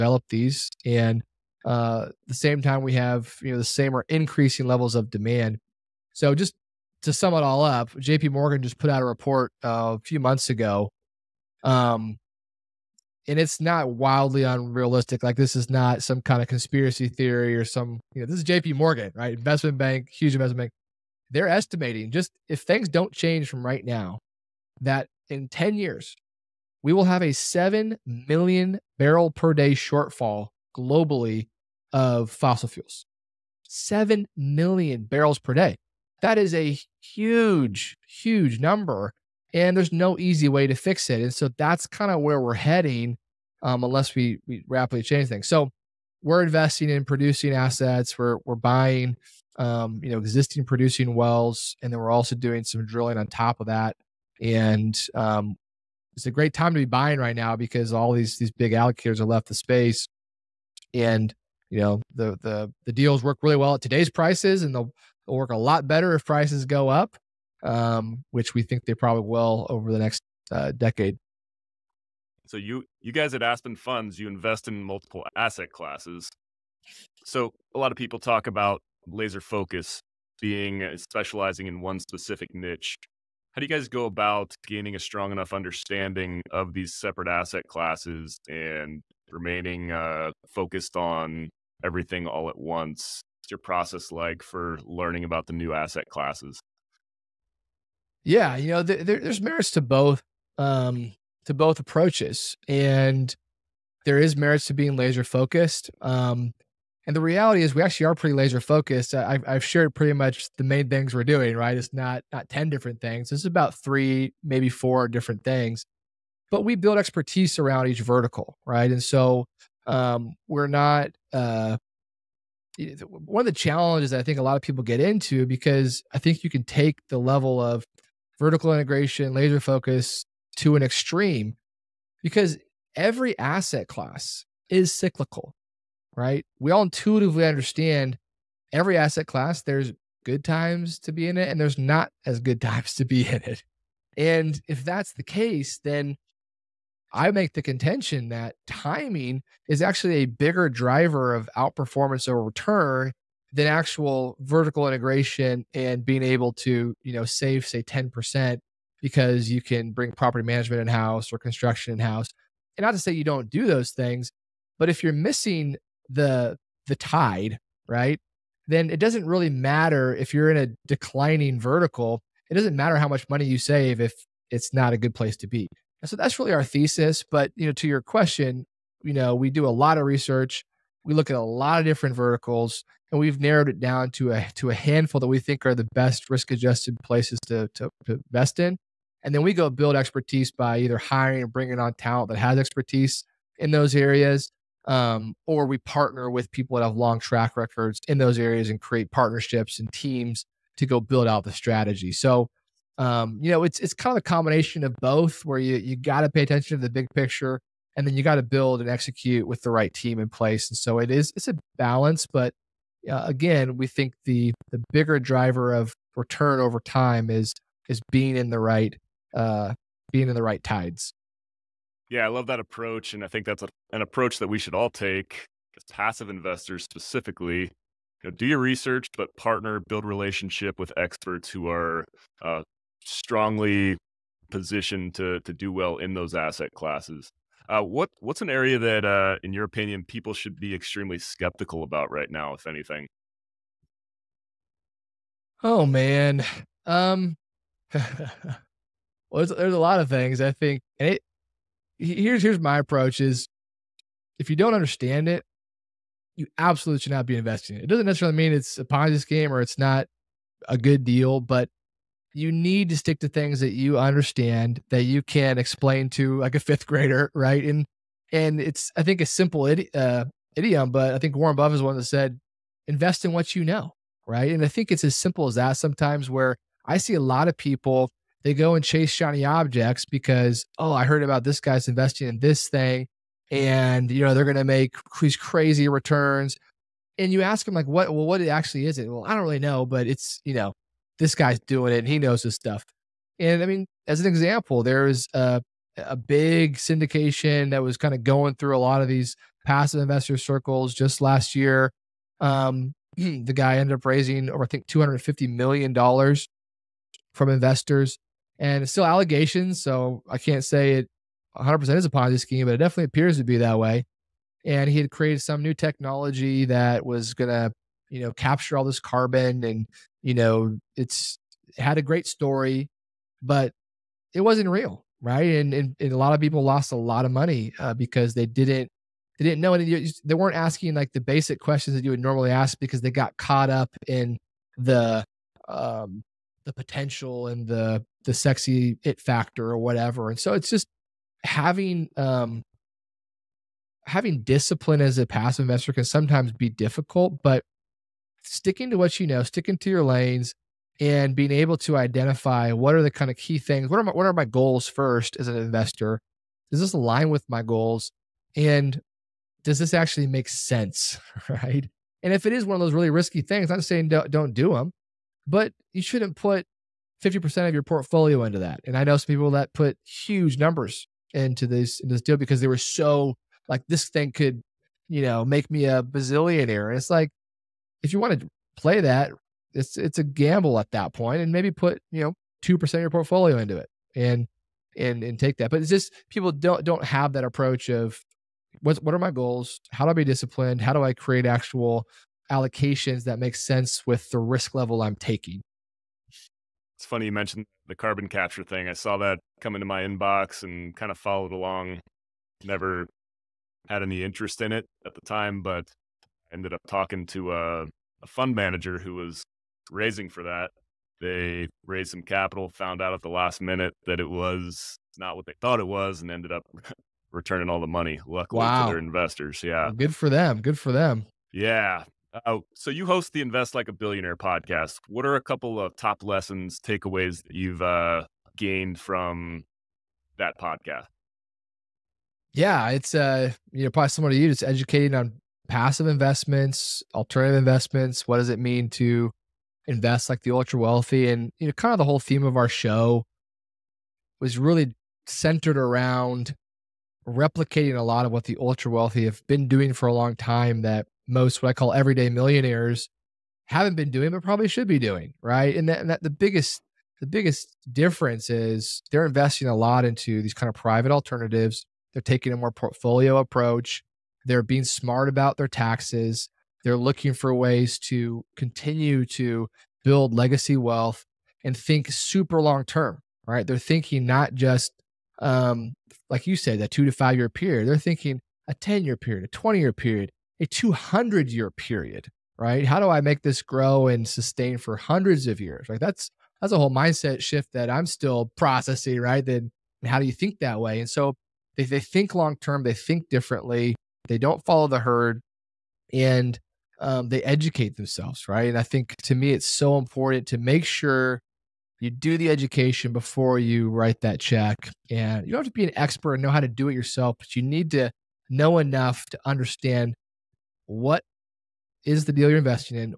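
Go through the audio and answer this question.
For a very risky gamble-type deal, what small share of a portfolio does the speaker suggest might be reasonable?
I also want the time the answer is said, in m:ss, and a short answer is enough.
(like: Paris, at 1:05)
2%, at 6:22.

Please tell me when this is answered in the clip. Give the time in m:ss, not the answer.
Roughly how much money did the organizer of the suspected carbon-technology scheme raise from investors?
5:04.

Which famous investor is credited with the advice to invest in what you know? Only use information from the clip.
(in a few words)
Warren Buffett.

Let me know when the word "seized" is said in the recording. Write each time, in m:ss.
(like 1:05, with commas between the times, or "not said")
not said.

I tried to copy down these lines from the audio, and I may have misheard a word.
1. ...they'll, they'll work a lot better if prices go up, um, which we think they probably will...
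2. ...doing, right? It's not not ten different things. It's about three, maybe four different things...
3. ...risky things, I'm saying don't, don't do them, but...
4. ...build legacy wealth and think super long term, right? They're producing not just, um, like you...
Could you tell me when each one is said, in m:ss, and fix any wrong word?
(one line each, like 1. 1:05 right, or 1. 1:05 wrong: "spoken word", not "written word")
1. 1:04 right
2. 1:51 right
3. 6:03 right
4. 7:50 wrong: "thinking", not "producing".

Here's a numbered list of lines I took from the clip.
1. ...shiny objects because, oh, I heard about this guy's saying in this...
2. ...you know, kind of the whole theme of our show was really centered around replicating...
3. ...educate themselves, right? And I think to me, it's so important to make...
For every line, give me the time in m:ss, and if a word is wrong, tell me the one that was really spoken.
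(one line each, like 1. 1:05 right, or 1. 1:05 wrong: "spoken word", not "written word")
1. 4:39 wrong: "investing", not "saying"
2. 7:21 right
3. 8:17 right.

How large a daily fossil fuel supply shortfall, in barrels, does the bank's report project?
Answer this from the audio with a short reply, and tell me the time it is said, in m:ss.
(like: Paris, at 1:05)
7 million barrels per day, at 0:33.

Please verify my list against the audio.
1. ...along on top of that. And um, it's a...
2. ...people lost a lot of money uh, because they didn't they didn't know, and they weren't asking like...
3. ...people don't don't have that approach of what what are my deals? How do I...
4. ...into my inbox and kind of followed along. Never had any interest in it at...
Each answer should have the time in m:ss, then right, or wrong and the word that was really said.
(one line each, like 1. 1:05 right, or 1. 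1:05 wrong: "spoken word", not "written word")
1. 0:52 wrong: "drilling", not "along"
2. 5:26 right
3. 6:26 wrong: "goals", not "deals"
4. 6:39 right.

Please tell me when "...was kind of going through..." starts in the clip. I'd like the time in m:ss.
4:57.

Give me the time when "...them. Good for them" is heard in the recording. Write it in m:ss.
7:00.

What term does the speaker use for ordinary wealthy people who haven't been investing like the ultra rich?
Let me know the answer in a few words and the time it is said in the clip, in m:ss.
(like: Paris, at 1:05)
everyday millionaires, at 7:31.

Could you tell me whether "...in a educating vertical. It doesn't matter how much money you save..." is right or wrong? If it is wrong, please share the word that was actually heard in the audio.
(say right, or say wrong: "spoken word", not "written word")
wrong: "declining", not "educating".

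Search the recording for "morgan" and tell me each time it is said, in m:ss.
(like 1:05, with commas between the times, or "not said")
0:08, 0:18.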